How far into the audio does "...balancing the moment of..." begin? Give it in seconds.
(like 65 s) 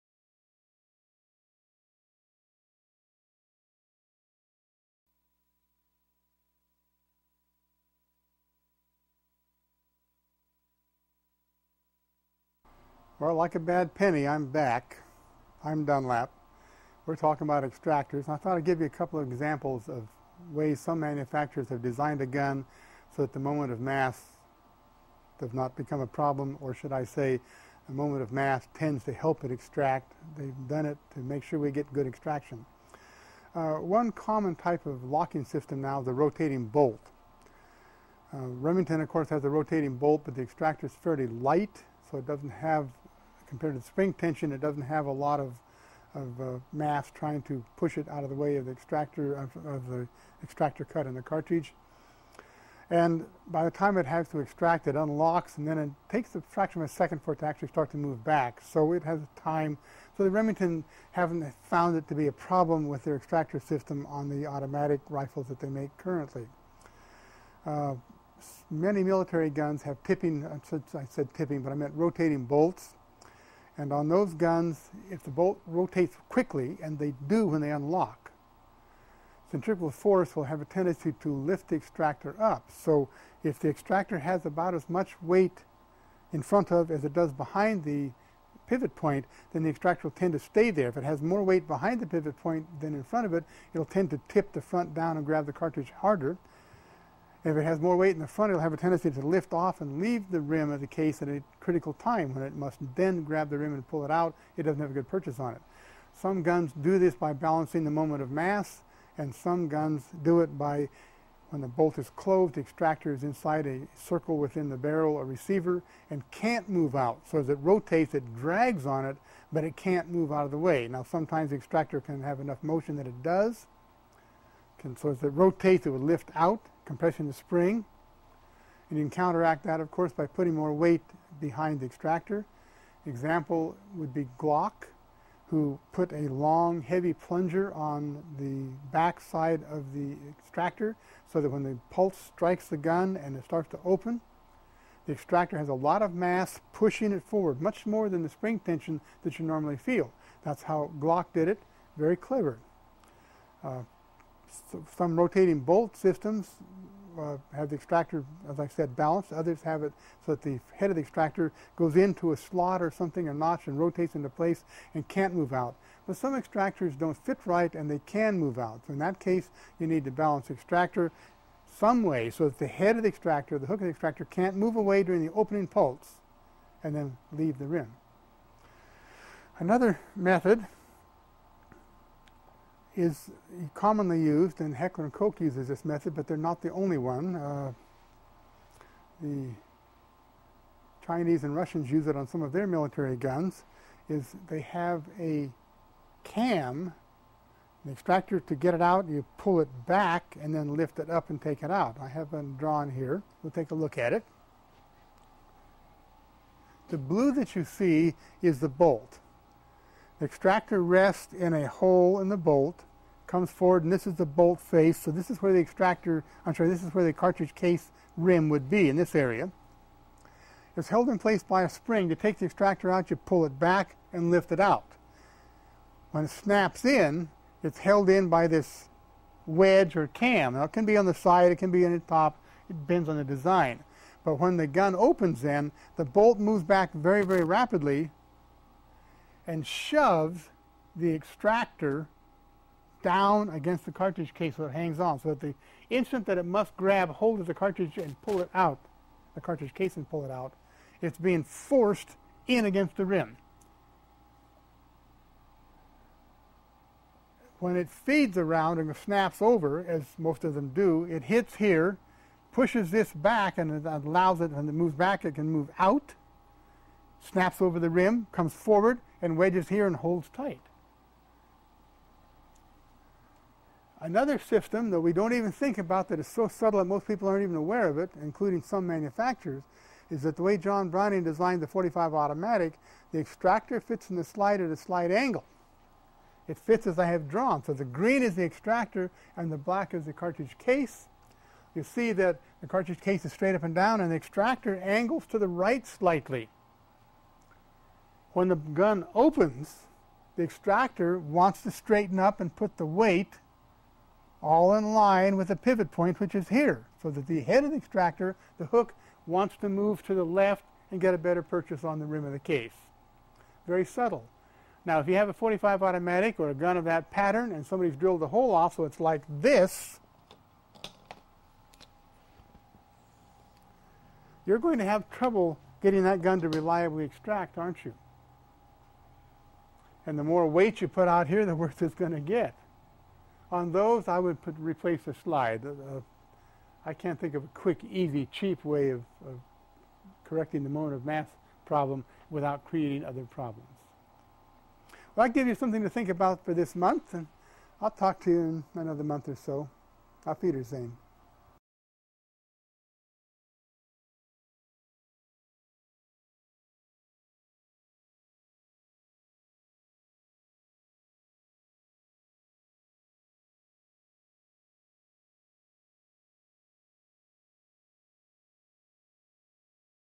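107 s.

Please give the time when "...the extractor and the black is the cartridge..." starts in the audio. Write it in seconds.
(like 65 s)
288 s.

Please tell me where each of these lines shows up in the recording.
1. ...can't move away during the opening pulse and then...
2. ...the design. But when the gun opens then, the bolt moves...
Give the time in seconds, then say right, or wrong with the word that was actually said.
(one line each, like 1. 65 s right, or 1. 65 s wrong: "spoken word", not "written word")
1. 174 s right
2. 233 s right.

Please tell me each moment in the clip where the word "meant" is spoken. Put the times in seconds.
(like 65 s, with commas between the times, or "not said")
71 s.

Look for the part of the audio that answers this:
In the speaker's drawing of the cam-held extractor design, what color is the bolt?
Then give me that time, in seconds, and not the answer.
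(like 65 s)
206 s.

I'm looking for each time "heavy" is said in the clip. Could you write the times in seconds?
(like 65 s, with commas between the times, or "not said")
136 s.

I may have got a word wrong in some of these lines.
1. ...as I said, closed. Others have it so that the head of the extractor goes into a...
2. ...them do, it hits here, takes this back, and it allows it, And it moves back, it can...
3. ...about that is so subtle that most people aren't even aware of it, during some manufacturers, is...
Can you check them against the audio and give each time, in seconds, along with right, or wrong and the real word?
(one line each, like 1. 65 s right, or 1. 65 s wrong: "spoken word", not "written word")
1. 158 s wrong: "balanced", not "closed"
2. 260 s wrong: "pushes", not "takes"
3. 275 s wrong: "including", not "during".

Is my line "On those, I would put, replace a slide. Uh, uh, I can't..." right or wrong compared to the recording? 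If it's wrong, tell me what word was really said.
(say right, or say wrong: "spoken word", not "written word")
right.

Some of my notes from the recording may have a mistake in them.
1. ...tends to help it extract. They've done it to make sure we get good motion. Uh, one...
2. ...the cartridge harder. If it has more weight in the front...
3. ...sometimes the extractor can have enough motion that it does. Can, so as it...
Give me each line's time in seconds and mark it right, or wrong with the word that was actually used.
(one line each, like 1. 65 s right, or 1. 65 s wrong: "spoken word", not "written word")
1. 28 s wrong: "extraction", not "motion"
2. 95 s right
3. 121 s right.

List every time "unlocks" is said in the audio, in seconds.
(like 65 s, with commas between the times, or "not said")
54 s, 77 s.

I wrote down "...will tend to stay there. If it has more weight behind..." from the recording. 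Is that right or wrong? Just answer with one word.
right.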